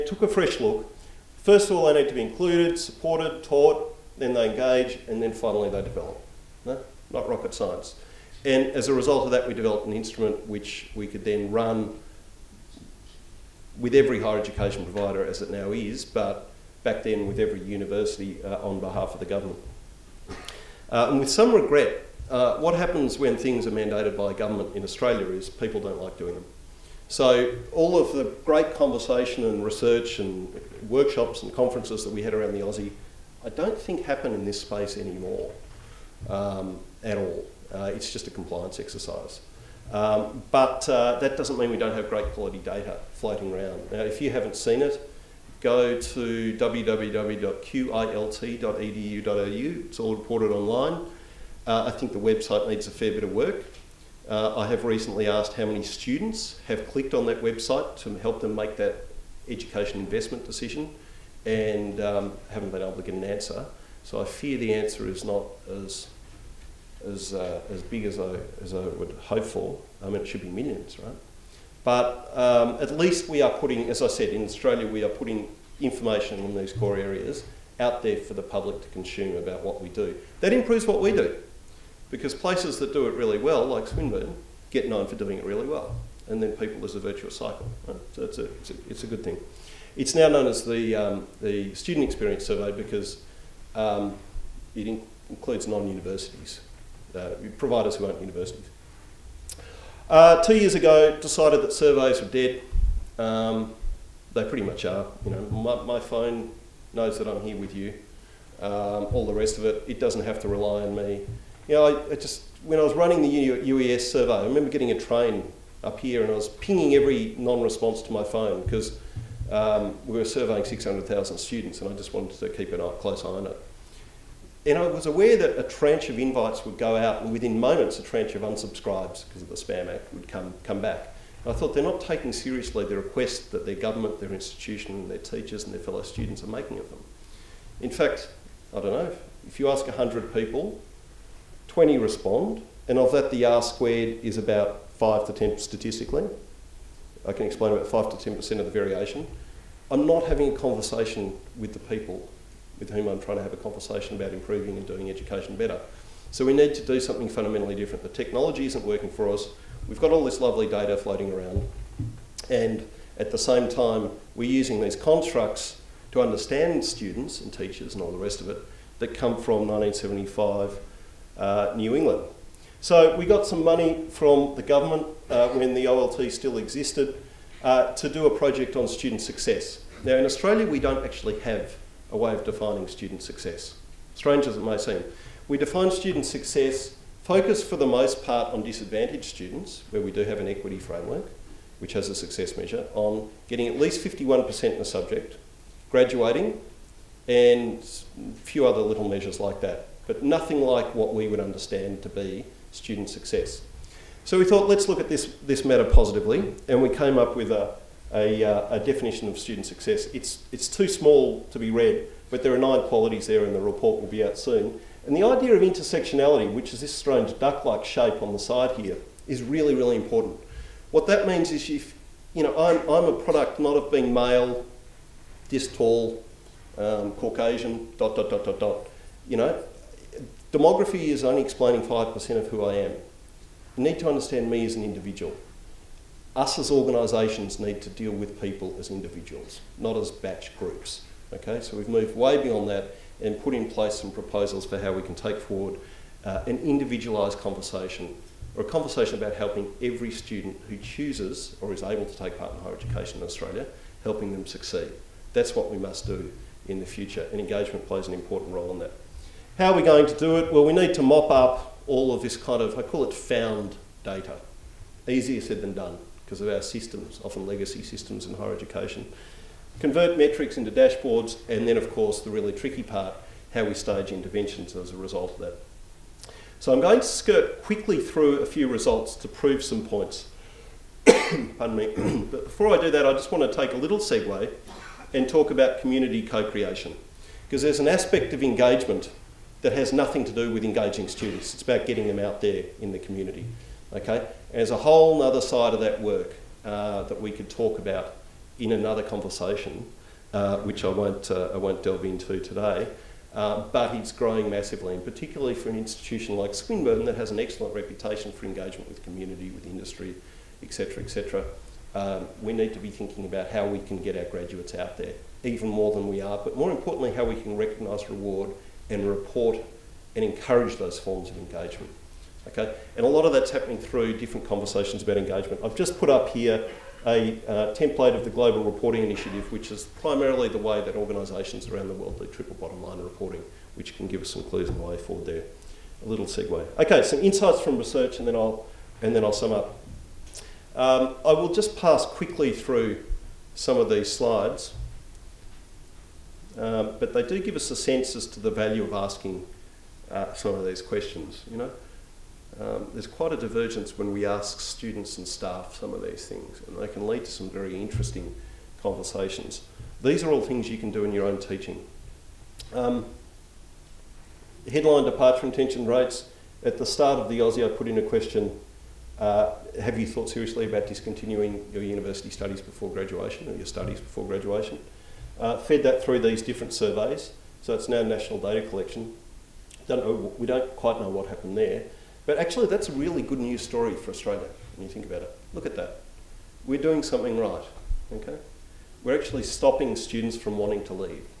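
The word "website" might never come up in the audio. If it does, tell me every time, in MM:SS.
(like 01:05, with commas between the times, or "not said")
00:52, 00:57.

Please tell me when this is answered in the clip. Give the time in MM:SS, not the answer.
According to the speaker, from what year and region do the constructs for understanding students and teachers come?
02:49.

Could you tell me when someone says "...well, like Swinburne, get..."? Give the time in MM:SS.
01:23.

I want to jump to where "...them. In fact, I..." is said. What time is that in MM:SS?
02:16.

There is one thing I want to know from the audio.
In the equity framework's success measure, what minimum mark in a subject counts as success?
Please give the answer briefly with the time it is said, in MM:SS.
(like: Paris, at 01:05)
51%, at 03:14.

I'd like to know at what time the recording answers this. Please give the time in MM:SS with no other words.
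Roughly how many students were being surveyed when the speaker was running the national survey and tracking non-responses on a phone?
02:00.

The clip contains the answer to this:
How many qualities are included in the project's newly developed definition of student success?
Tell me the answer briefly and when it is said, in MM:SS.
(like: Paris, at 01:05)
9, at 03:32.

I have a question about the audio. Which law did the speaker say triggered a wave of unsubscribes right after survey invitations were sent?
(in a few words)
Spam Act.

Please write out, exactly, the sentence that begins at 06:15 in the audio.
uh, fed that through these different surveys.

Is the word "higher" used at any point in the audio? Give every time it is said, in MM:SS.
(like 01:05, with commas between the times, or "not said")
00:14, 04:12, 04:28.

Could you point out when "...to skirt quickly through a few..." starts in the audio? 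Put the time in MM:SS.
04:36.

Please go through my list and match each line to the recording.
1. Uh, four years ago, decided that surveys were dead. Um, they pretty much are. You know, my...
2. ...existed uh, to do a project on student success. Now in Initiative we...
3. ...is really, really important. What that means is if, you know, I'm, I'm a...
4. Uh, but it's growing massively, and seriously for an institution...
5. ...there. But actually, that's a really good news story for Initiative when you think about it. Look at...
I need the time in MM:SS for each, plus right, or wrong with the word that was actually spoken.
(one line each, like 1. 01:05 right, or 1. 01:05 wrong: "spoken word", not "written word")
1. 01:40 wrong: "two", not "four"
2. 02:56 wrong: "Australia", not "Initiative"
3. 03:39 right
4. 05:03 wrong: "particularly", not "seriously"
5. 06:21 wrong: "Australia", not "Initiative".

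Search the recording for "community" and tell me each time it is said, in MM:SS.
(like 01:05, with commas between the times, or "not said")
04:45, 04:52, 05:09.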